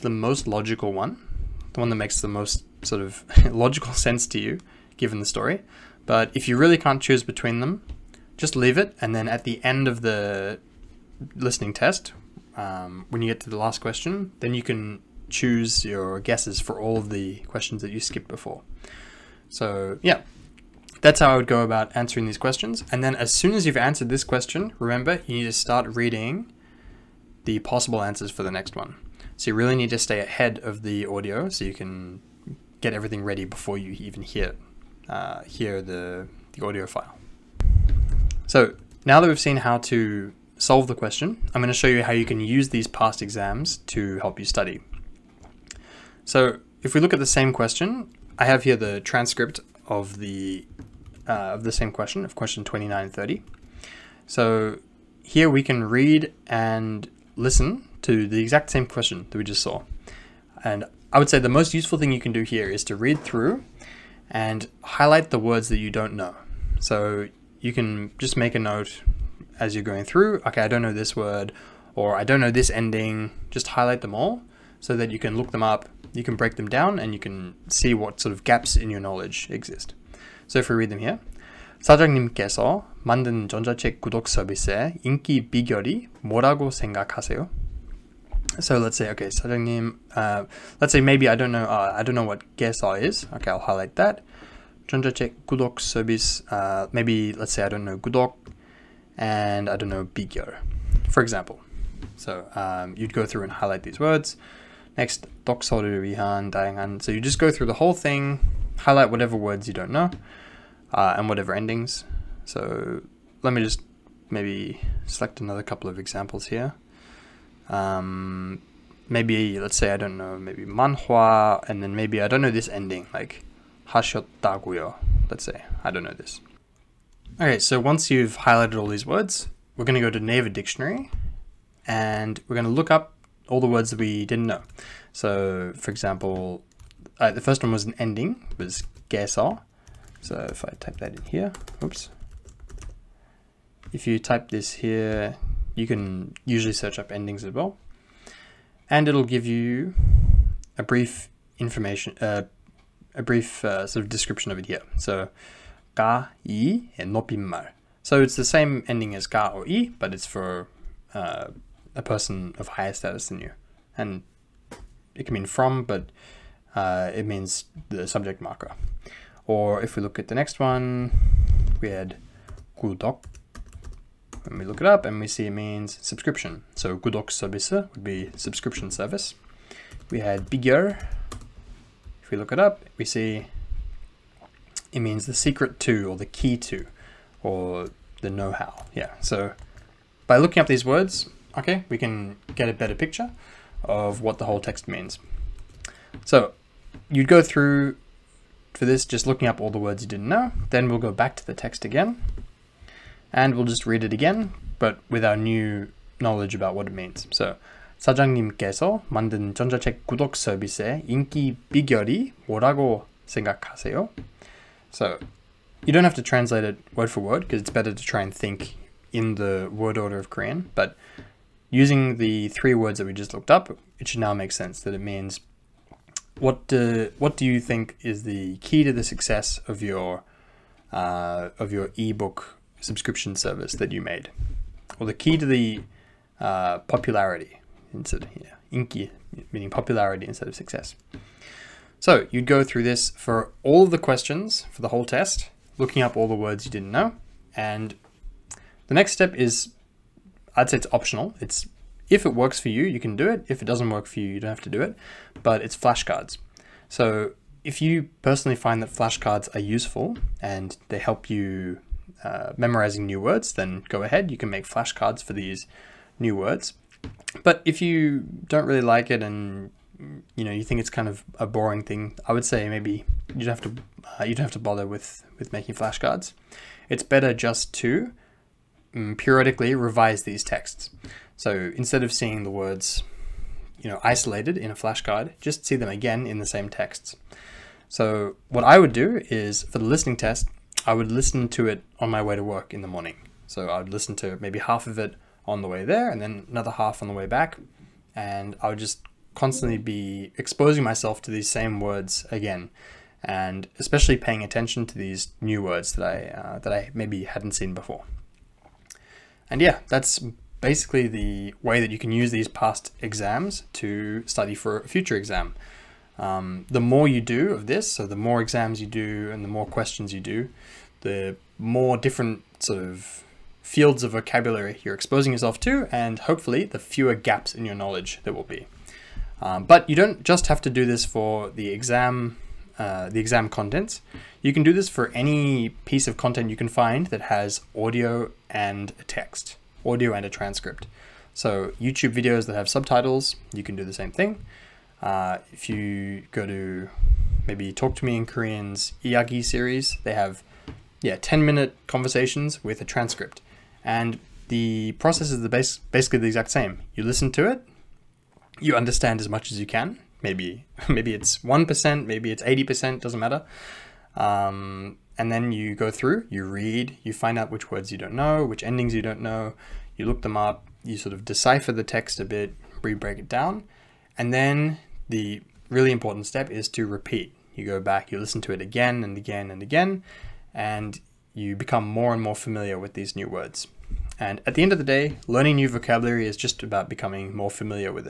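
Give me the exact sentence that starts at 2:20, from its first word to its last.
So if I type that in here, oops.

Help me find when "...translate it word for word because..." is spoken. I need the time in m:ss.
3:36.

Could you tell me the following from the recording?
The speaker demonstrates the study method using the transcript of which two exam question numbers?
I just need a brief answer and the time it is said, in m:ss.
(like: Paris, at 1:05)
29 and 30, at 0:52.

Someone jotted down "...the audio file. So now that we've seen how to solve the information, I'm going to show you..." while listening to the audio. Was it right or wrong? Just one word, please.
wrong.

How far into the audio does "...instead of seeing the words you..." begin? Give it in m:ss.
4:41.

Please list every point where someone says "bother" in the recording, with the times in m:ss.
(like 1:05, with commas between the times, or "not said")
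4:34.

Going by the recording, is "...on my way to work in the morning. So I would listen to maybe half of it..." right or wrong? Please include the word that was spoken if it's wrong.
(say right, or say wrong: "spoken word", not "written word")
right.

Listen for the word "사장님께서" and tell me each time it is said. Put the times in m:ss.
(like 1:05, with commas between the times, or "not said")
1:21, 3:27.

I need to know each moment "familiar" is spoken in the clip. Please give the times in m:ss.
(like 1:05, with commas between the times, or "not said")
6:22, 6:27.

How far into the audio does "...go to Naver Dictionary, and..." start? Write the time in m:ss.
2:10.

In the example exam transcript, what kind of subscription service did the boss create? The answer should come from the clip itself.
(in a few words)
ebook subscription service.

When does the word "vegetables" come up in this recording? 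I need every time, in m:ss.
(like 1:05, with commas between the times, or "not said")
not said.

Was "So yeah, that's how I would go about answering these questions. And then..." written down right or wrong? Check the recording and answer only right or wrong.
right.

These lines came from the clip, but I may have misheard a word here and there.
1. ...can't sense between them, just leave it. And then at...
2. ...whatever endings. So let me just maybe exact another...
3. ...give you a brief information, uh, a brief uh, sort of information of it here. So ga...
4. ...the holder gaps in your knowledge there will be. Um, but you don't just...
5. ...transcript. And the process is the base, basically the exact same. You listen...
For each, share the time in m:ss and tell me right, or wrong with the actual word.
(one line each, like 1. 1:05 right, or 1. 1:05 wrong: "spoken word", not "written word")
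1. 0:06 wrong: "choose", not "sense"
2. 1:51 wrong: "select", not "exact"
3. 2:29 wrong: "description", not "information"
4. 5:26 wrong: "fewer", not "holder"
5. 5:52 right.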